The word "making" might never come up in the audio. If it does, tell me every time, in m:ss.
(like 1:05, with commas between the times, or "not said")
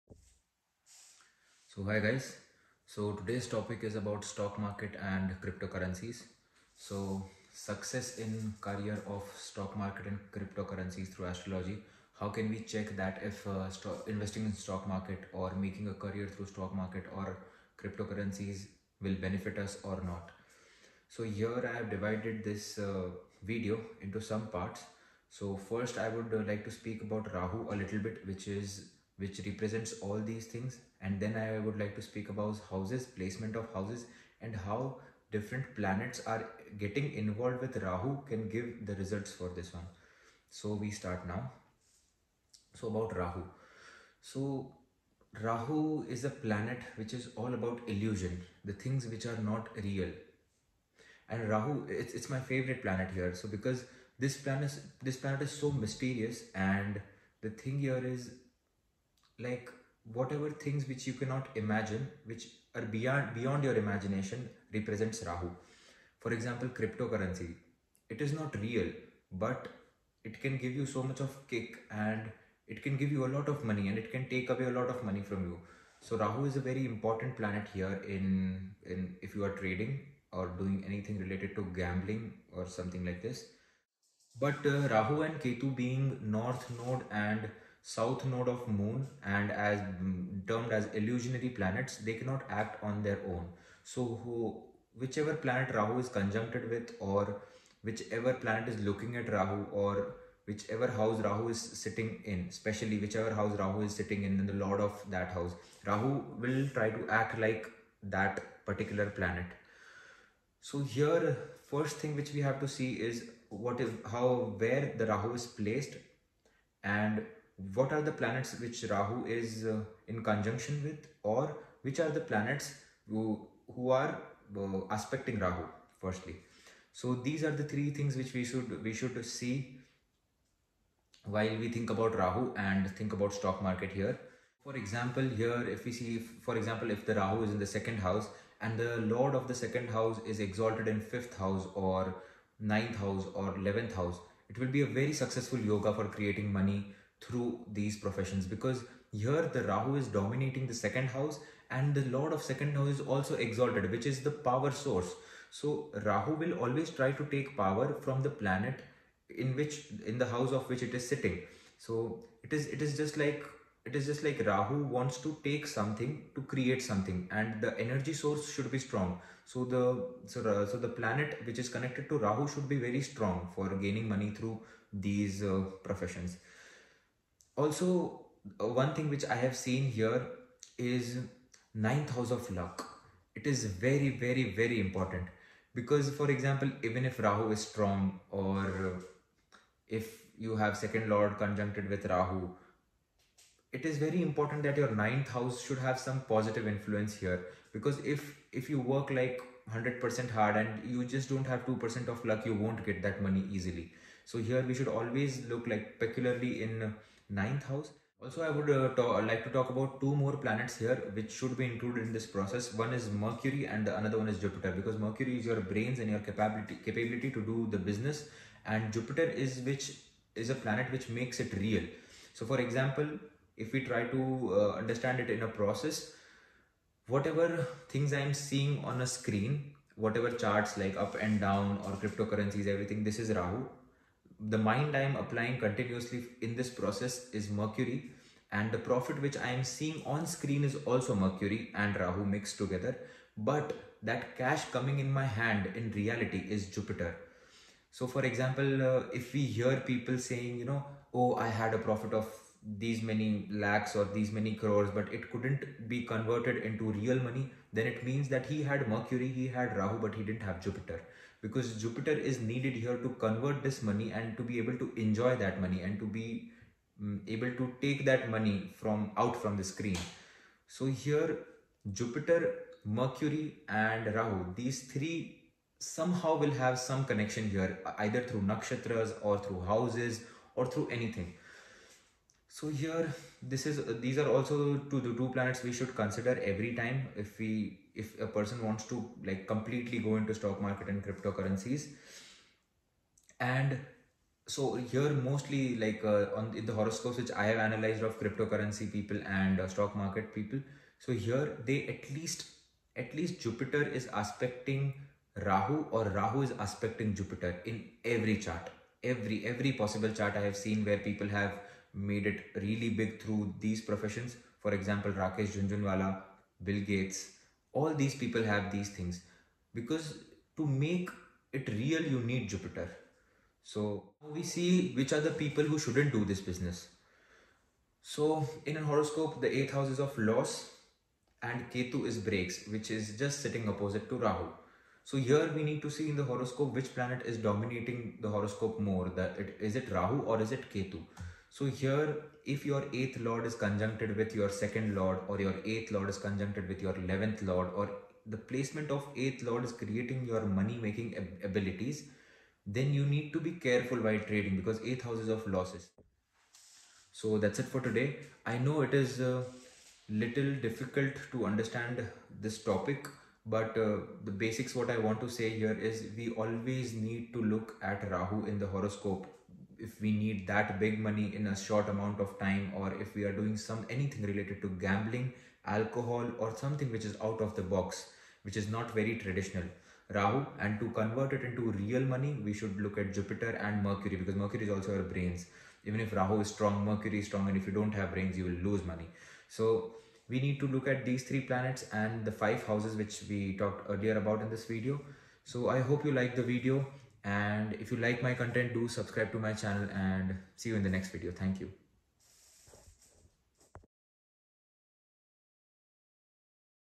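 0:15, 5:50.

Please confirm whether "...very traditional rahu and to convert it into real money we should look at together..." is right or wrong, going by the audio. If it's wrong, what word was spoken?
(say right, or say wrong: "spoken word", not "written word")
wrong: "jupiter", not "together".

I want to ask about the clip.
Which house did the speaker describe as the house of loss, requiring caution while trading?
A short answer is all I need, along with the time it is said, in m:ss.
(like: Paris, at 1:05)
eighth house, at 5:29.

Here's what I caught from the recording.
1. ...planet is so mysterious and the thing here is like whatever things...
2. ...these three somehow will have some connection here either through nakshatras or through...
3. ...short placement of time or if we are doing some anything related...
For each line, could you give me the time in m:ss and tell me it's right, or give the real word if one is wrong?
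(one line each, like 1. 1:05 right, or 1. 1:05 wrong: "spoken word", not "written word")
1. 0:55 right
2. 4:34 right
3. 6:11 wrong: "amount", not "placement".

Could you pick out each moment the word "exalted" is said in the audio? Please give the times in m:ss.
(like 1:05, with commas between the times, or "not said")
2:20, 2:33.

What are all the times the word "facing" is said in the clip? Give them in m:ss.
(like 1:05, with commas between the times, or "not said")
not said.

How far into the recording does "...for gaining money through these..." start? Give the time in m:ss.
2:53.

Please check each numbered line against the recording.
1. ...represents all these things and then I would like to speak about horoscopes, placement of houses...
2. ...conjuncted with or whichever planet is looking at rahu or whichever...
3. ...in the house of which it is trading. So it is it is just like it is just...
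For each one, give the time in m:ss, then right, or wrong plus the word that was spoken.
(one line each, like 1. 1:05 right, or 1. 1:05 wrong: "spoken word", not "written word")
1. 0:29 wrong: "houses", not "horoscopes"
2. 1:36 right
3. 2:40 wrong: "sitting", not "trading".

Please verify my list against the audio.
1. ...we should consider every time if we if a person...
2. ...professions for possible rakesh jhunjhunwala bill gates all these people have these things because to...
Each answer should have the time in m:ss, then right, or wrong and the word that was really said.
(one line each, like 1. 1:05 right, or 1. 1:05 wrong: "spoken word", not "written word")
1. 4:45 right
2. 5:13 wrong: "example", not "possible".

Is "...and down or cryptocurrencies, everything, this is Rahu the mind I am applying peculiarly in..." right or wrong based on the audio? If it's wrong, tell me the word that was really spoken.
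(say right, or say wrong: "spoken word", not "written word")
wrong: "continuously", not "peculiarly".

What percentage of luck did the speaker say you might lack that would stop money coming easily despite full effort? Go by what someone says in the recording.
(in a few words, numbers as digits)
2%.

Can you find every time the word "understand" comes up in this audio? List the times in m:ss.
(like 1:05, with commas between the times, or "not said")
3:44, 6:01.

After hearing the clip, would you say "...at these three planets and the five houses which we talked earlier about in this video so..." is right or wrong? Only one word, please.
right.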